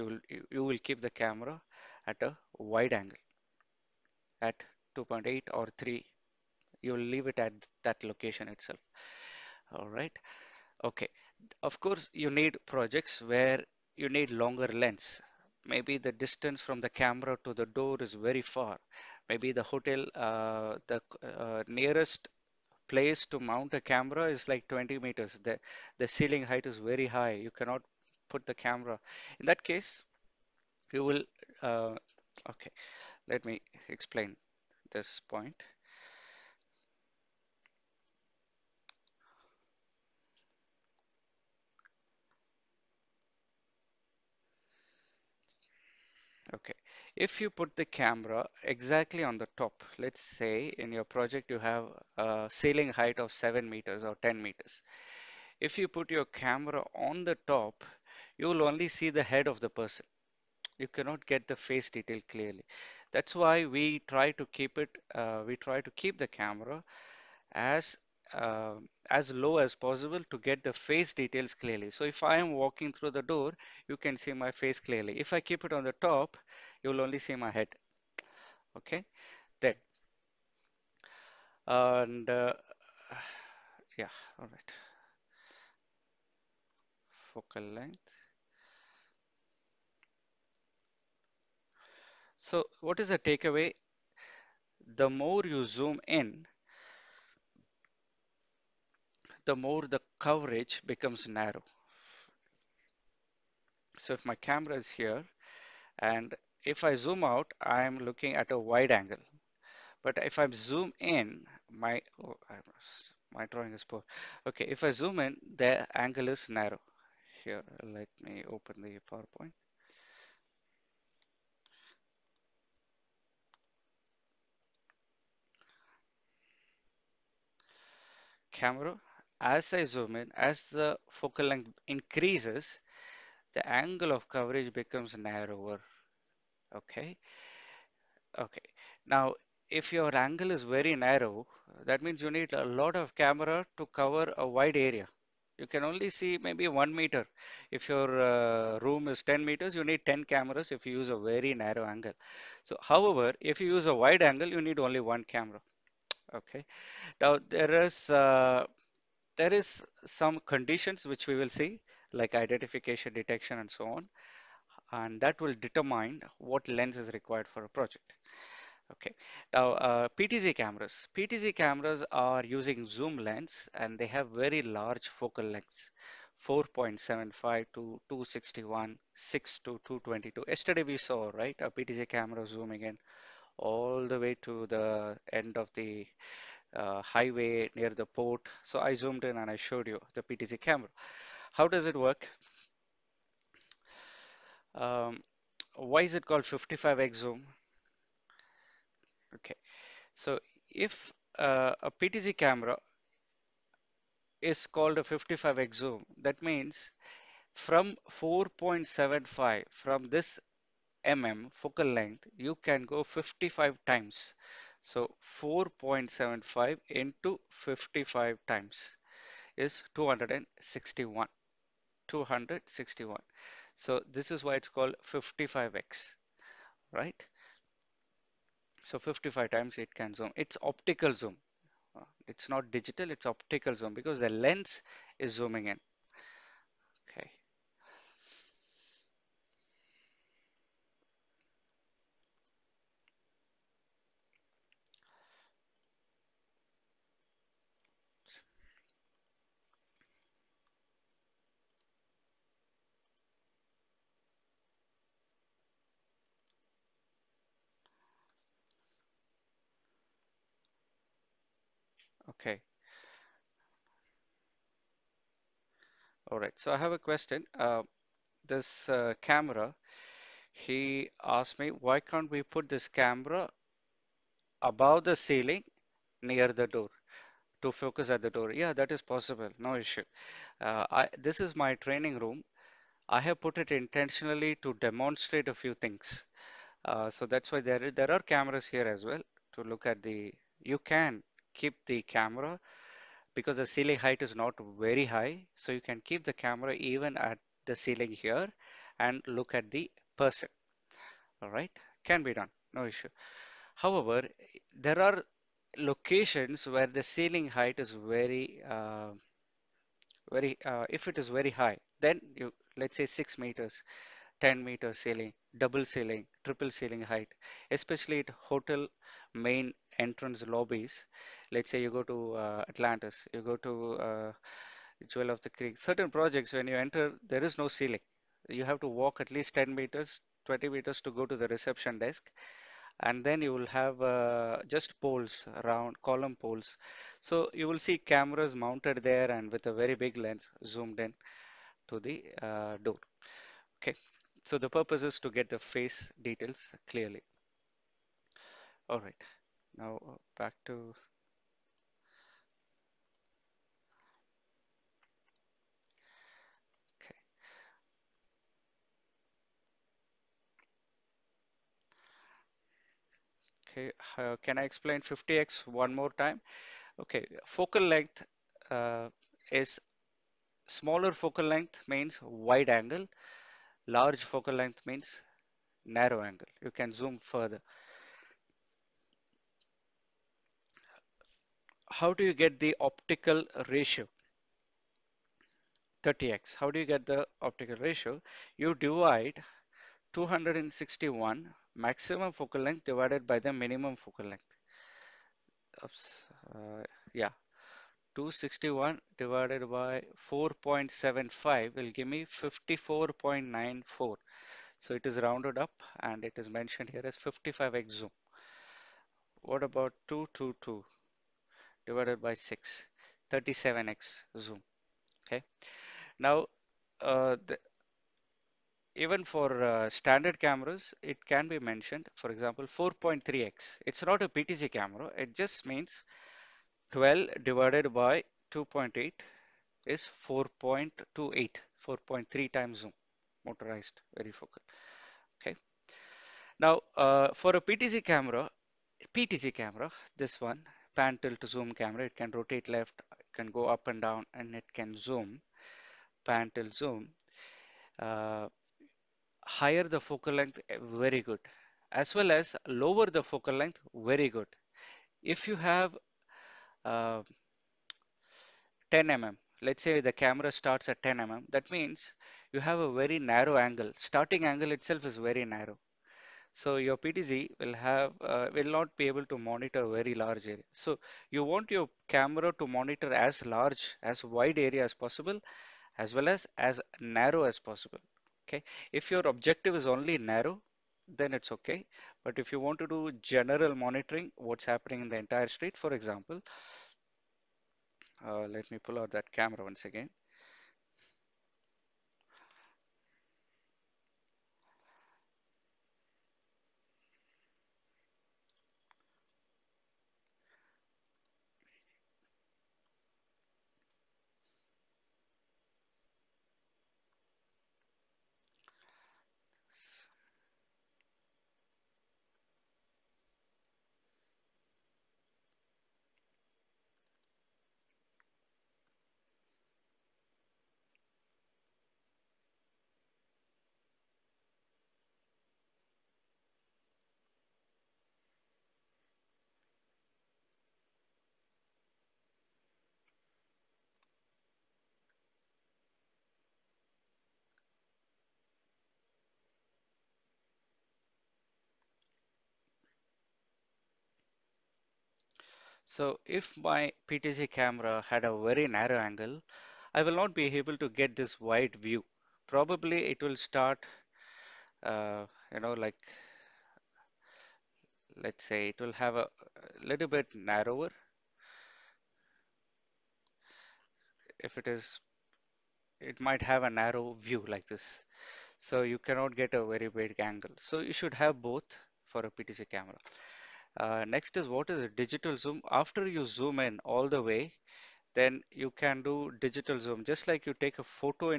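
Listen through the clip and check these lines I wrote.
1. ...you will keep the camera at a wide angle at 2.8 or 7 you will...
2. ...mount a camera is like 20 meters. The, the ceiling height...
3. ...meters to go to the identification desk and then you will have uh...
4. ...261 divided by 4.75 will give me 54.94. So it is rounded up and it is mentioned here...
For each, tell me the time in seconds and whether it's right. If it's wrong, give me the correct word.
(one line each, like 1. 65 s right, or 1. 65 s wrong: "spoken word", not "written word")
1. 0 s wrong: "3", not "7"
2. 23 s right
3. 330 s wrong: "reception", not "identification"
4. 398 s right.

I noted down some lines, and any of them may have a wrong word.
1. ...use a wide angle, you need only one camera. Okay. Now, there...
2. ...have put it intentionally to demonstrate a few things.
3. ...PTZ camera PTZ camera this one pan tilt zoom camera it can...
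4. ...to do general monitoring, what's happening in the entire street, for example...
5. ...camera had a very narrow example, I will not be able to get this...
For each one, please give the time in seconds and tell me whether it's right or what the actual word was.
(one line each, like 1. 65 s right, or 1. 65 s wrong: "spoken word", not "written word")
1. 153 s right
2. 283 s right
3. 437 s right
4. 482 s right
5. 547 s wrong: "angle", not "example".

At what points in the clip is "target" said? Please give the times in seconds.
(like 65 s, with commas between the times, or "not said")
not said.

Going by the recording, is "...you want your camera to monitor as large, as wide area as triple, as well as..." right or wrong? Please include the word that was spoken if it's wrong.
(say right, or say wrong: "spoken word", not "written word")
wrong: "possible", not "triple".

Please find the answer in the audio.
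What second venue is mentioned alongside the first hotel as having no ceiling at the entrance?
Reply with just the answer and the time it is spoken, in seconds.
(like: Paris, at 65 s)
Jewel of the Creek, at 325 s.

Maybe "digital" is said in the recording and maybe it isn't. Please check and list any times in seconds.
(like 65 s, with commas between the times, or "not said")
232 s, 574 s, 579 s.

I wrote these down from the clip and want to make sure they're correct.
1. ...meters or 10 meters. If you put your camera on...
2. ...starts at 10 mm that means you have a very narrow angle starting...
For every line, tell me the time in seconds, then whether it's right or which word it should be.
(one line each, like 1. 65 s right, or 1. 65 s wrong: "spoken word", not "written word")
1. 53 s right
2. 460 s right.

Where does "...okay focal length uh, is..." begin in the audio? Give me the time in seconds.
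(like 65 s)
366 s.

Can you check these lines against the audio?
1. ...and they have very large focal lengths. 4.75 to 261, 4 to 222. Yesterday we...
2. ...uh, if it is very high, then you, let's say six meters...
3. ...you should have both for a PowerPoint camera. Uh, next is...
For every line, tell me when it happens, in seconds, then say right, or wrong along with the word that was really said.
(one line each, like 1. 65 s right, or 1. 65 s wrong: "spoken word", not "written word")
1. 173 s wrong: "6", not "4"
2. 310 s right
3. 570 s wrong: "PTZ", not "PowerPoint".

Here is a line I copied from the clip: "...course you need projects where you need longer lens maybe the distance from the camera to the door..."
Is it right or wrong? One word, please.
right.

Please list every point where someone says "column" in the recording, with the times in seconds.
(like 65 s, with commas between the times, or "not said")
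336 s.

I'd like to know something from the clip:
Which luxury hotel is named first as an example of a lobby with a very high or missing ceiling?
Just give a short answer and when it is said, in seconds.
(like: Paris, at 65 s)
Atlantis, at 322 s.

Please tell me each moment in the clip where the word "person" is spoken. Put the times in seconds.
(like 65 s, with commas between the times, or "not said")
59 s, 300 s.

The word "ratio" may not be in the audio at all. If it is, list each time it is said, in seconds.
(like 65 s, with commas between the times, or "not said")
383 s, 387 s.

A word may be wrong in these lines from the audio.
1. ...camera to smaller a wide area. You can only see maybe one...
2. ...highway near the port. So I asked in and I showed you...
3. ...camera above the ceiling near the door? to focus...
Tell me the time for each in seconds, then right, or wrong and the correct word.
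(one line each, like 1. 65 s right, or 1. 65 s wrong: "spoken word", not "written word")
1. 143 s wrong: "cover", not "smaller"
2. 187 s wrong: "zoomed", not "asked"
3. 272 s right.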